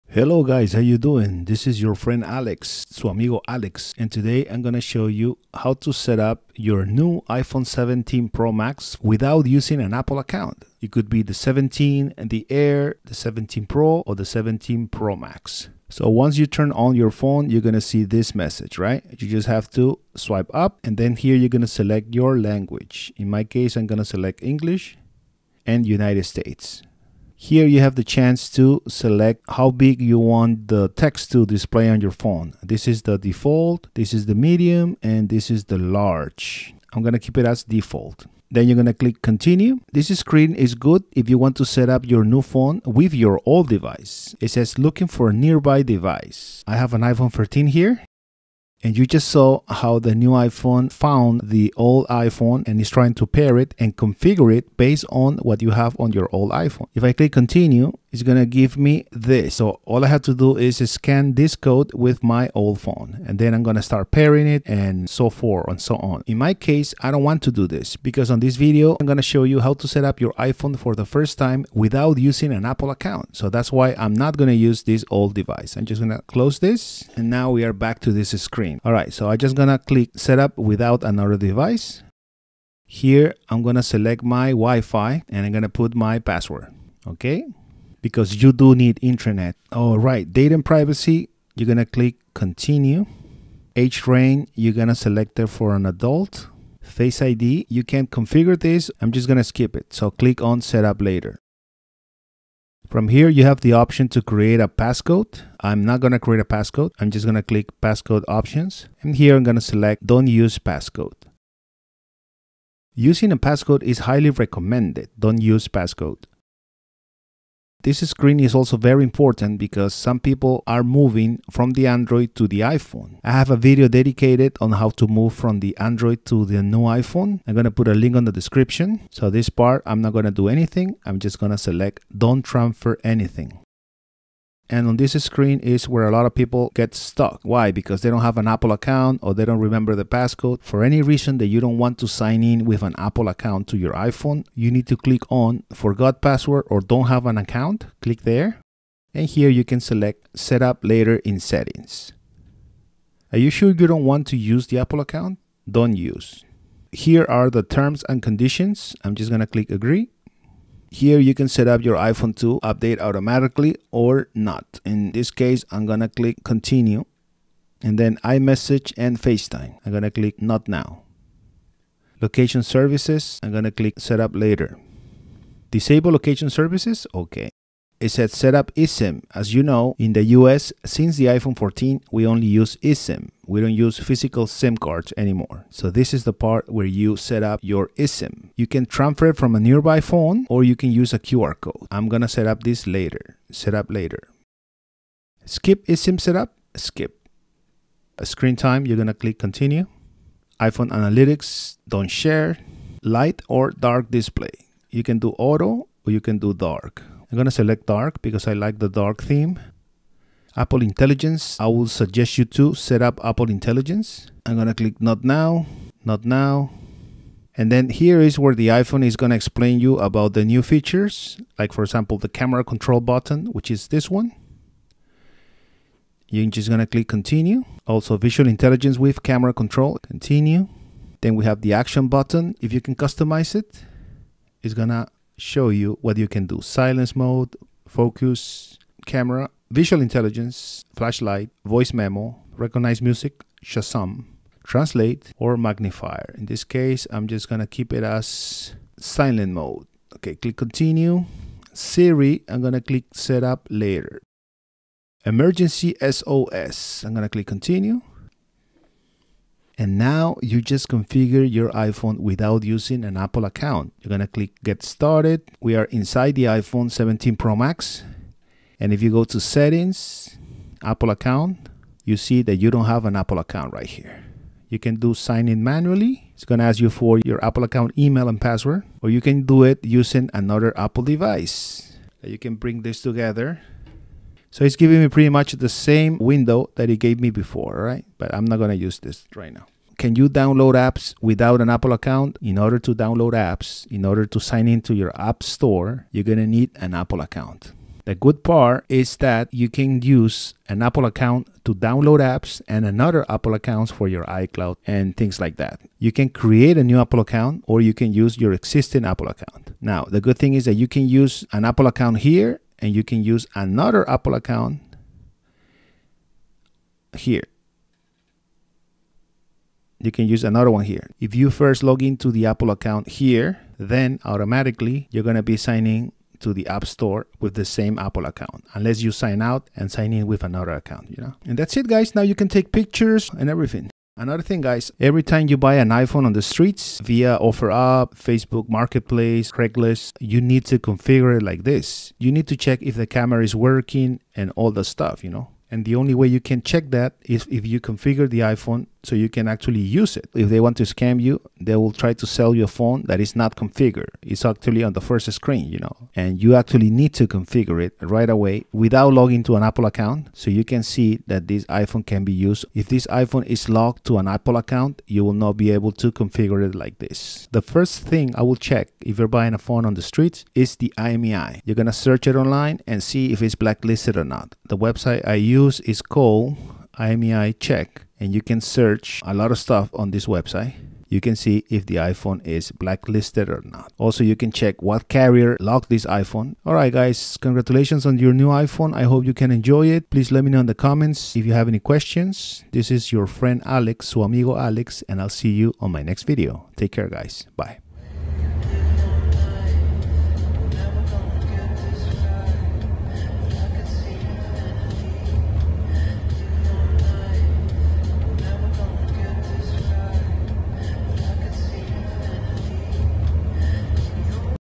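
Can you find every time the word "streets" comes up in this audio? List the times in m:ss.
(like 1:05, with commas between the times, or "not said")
5:36, 6:10.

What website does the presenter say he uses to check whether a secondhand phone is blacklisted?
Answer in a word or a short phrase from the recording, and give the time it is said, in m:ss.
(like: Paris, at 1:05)
IMEI Check, at 6:16.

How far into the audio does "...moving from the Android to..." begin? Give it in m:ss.
2:00.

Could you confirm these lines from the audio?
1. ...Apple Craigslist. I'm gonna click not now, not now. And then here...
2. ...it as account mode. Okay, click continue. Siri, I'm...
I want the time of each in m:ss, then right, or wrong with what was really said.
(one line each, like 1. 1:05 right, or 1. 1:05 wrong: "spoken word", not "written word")
1. 3:33 wrong: "Intelligence", not "Craigslist"
2. 4:07 wrong: "silent", not "account".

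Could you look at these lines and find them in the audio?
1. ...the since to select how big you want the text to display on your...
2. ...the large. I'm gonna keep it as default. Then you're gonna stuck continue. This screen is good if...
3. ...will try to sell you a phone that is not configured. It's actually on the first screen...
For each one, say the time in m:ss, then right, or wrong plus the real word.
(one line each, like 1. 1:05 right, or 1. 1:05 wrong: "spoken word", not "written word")
1. 0:27 wrong: "chance", not "since"
2. 0:35 wrong: "click", not "stuck"
3. 5:51 right.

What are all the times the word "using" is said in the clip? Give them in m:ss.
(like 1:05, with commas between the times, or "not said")
0:09, 1:12, 1:52, 4:22, 4:39.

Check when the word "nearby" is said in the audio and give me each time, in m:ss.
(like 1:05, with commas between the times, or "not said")
0:45, 3:09.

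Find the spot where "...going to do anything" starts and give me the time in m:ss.
2:10.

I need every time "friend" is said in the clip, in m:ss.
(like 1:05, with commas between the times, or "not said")
0:01, 6:33.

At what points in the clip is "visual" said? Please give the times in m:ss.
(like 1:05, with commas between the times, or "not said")
3:48, 3:59.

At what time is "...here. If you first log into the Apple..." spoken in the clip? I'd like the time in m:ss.
5:20.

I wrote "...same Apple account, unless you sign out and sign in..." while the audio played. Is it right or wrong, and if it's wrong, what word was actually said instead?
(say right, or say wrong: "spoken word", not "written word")
right.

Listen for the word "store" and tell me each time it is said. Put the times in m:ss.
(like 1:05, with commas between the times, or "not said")
4:55, 5:26.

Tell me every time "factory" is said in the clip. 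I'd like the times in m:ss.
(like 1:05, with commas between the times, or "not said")
not said.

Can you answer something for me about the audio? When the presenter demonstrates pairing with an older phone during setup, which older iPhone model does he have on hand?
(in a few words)
iPhone 13.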